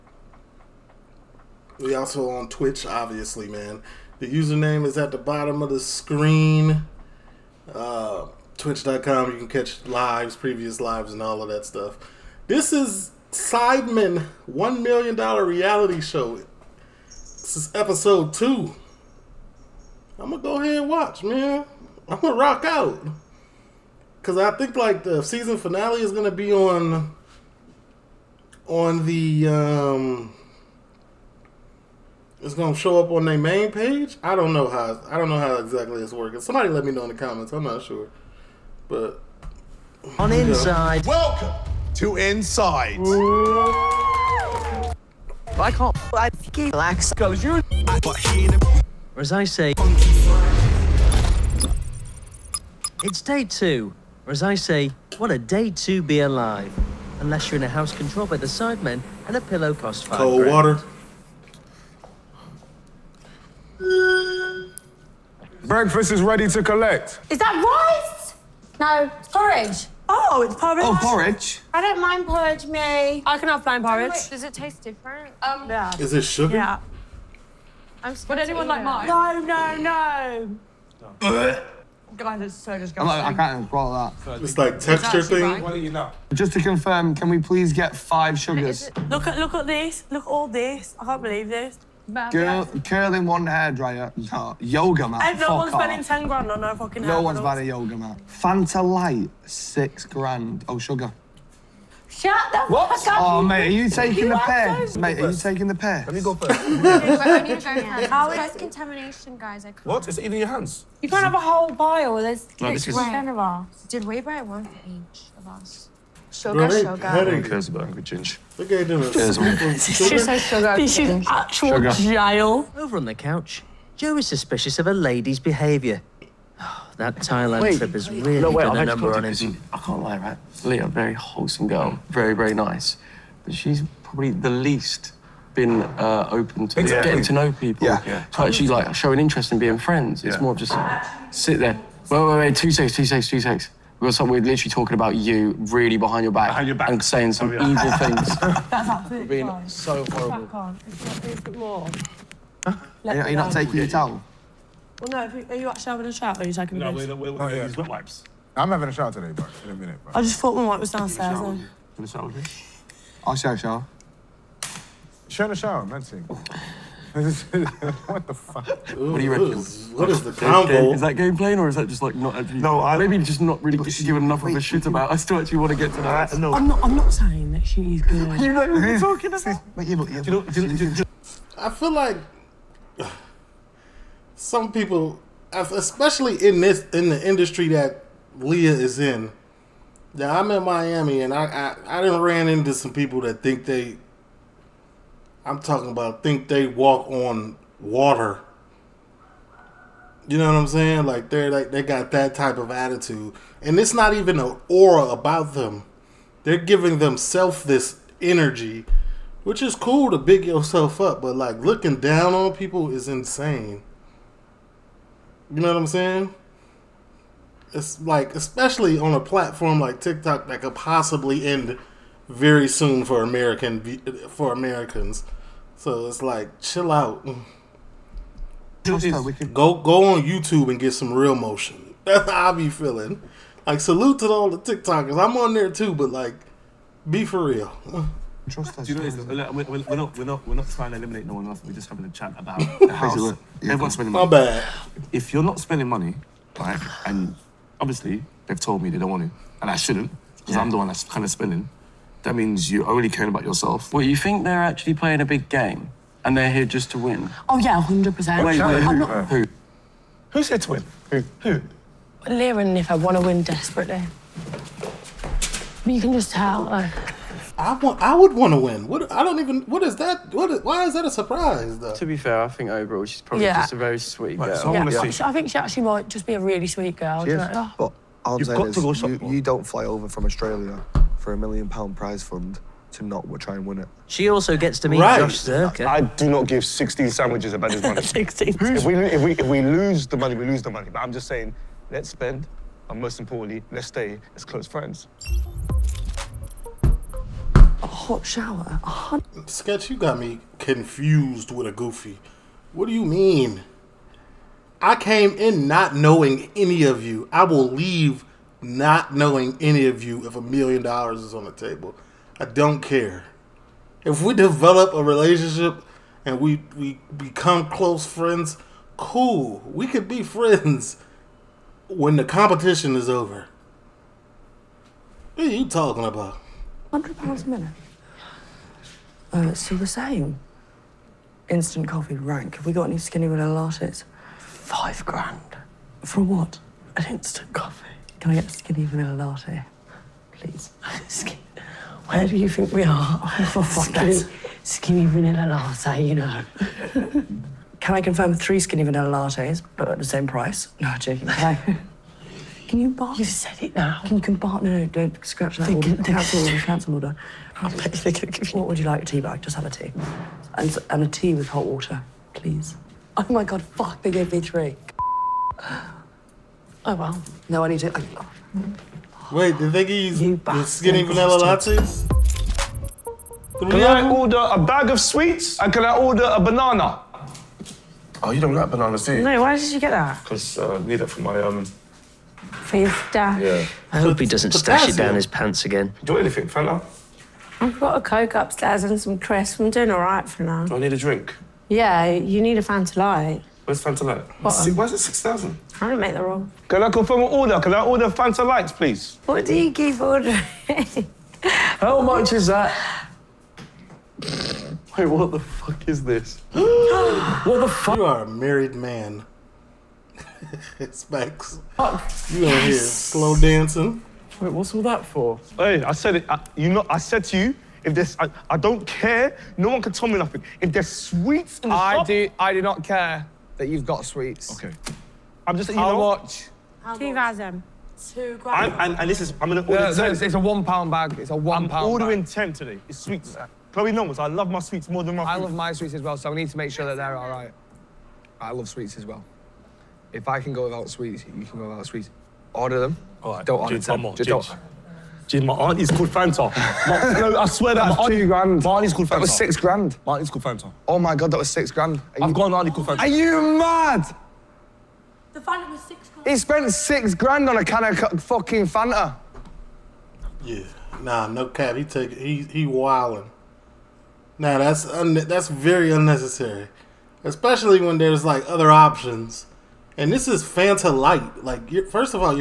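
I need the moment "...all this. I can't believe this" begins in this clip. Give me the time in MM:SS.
01:30.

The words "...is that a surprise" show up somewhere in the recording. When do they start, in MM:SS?
04:30.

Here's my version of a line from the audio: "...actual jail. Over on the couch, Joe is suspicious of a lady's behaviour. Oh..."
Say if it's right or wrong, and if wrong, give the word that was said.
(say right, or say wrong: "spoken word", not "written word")
right.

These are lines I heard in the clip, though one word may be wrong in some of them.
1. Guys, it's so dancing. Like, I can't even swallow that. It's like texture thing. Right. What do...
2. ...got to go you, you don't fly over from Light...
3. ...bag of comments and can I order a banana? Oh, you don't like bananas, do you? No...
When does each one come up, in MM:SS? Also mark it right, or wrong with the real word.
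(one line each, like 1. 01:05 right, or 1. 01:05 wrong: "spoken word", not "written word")
1. 01:22 wrong: "disgusting", not "dancing"
2. 04:38 wrong: "Australia", not "Light"
3. 06:14 wrong: "sweets", not "comments".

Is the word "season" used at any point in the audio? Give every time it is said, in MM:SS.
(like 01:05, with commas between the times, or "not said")
00:25.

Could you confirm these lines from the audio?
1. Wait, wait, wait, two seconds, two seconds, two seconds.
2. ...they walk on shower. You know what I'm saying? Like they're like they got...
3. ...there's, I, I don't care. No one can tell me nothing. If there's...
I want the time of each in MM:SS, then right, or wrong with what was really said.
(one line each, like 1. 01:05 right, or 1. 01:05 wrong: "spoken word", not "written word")
1. 02:22 right
2. 03:16 wrong: "water", not "shower"
3. 06:57 right.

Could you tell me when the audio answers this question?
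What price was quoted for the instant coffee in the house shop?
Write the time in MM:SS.
05:34.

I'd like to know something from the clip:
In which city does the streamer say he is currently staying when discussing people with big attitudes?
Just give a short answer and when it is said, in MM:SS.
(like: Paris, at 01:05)
Miami, at 03:10.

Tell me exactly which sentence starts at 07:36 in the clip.
He spent six grand on a can of fucking Fanta.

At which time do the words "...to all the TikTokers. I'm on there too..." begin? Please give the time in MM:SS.
03:54.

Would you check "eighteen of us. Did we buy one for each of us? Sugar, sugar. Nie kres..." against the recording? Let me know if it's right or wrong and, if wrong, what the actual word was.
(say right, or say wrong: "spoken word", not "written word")
wrong: "ten", not "eighteen".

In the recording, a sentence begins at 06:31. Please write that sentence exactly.
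Yeah, you need a Fanta Light.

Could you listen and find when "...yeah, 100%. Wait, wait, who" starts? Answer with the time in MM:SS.
04:17.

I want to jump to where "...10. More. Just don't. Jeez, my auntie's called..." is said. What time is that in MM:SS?
07:23.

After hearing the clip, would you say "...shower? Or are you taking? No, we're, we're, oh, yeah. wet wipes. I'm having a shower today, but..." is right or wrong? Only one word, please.
right.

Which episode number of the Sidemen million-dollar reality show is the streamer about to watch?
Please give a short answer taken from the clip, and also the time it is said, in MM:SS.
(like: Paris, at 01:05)
2, at 00:17.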